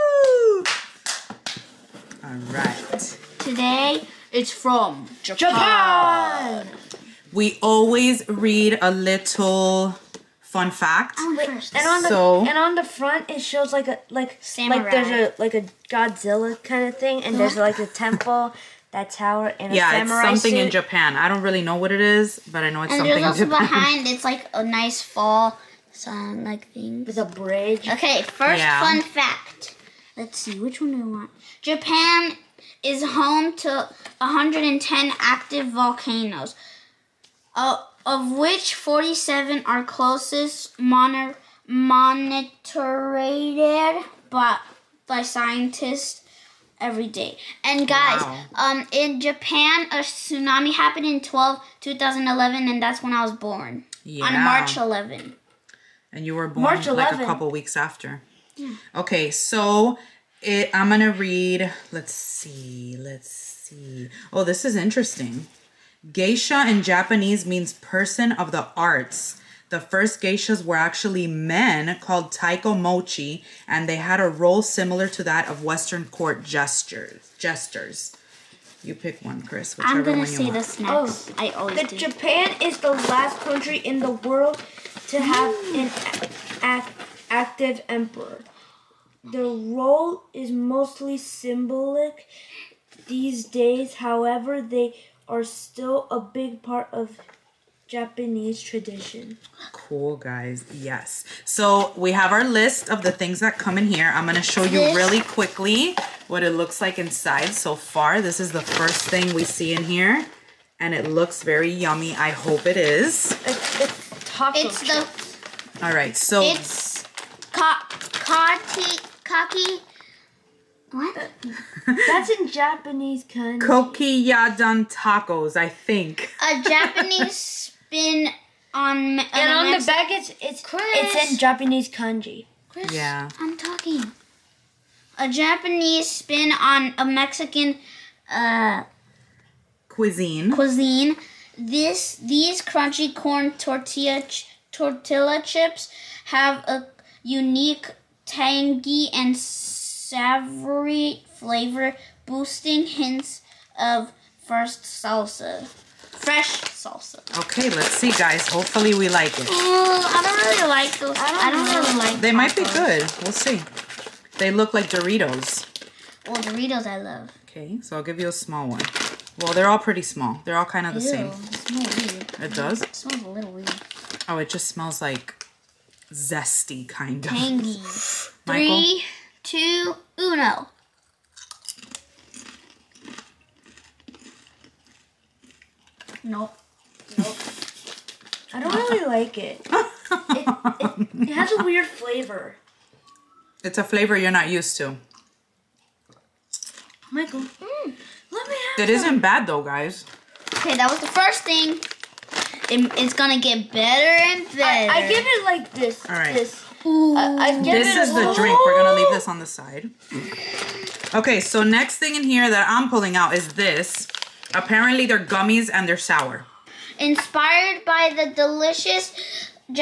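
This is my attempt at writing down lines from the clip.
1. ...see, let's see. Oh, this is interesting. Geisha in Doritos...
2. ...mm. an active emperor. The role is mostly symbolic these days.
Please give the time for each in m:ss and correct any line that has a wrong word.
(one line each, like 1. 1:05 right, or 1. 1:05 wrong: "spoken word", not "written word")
1. 1:02 wrong: "Japanese", not "Doritos"
2. 1:25 right.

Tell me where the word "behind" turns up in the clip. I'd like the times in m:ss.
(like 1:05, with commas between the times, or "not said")
0:23.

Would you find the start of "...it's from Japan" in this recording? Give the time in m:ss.
0:04.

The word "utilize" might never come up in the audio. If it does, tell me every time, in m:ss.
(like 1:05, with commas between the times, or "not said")
not said.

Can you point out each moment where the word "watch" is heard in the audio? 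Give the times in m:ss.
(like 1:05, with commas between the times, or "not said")
not said.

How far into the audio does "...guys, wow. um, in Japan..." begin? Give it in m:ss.
0:47.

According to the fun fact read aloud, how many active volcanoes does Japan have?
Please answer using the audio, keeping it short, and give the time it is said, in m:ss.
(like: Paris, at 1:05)
110, at 0:34.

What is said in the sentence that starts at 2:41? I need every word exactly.
I don't, I don't really like mm.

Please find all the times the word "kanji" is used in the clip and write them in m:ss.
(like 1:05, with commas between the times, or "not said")
2:03, 2:11.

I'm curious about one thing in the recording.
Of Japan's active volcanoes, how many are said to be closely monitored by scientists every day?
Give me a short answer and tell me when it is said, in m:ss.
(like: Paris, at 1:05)
47, at 0:38.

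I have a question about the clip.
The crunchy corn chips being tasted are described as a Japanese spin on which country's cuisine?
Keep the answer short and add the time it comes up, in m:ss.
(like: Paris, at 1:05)
Mexican, at 2:17.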